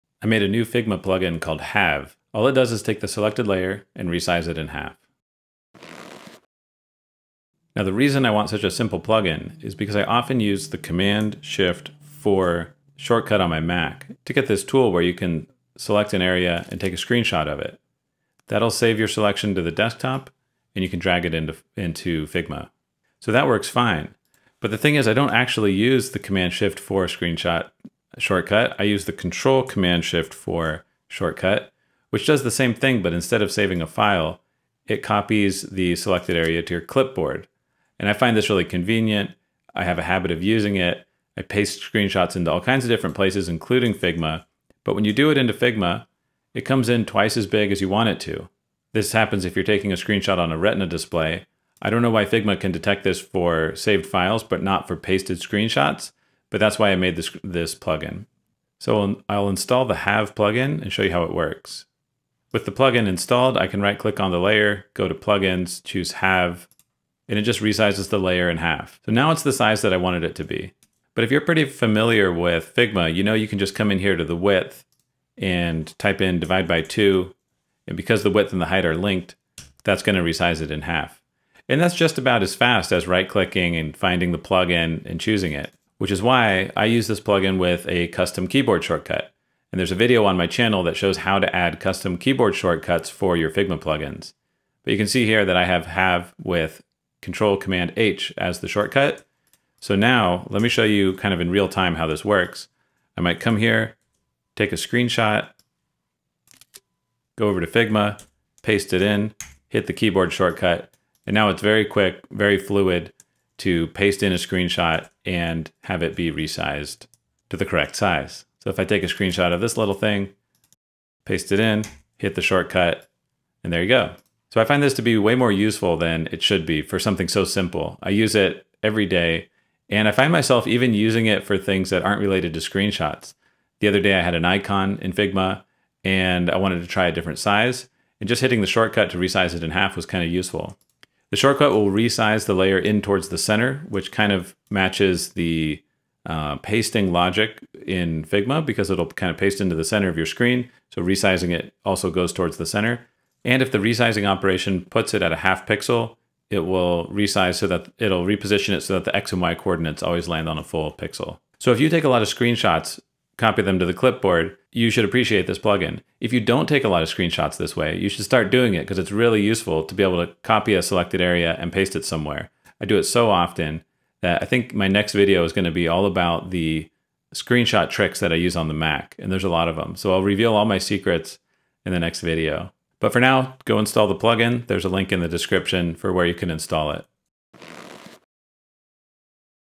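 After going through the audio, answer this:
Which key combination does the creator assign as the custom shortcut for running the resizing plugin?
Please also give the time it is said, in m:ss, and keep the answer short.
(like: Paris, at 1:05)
Control Command H, at 1:37.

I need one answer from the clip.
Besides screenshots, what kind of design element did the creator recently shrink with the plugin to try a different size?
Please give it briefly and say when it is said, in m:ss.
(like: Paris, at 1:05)
an icon, at 2:14.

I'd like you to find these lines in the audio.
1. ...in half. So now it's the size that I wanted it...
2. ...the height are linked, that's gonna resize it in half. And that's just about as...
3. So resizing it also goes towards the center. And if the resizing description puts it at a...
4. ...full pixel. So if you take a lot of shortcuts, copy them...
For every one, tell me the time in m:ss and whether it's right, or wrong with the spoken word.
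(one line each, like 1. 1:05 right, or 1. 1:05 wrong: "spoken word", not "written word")
1. 1:08 right
2. 1:18 right
3. 2:30 wrong: "operation", not "description"
4. 2:40 wrong: "screenshots", not "shortcuts".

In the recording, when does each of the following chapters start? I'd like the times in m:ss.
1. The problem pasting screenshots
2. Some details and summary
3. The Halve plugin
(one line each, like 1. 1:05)
1. 0:10
2. 2:04
3. 0:58.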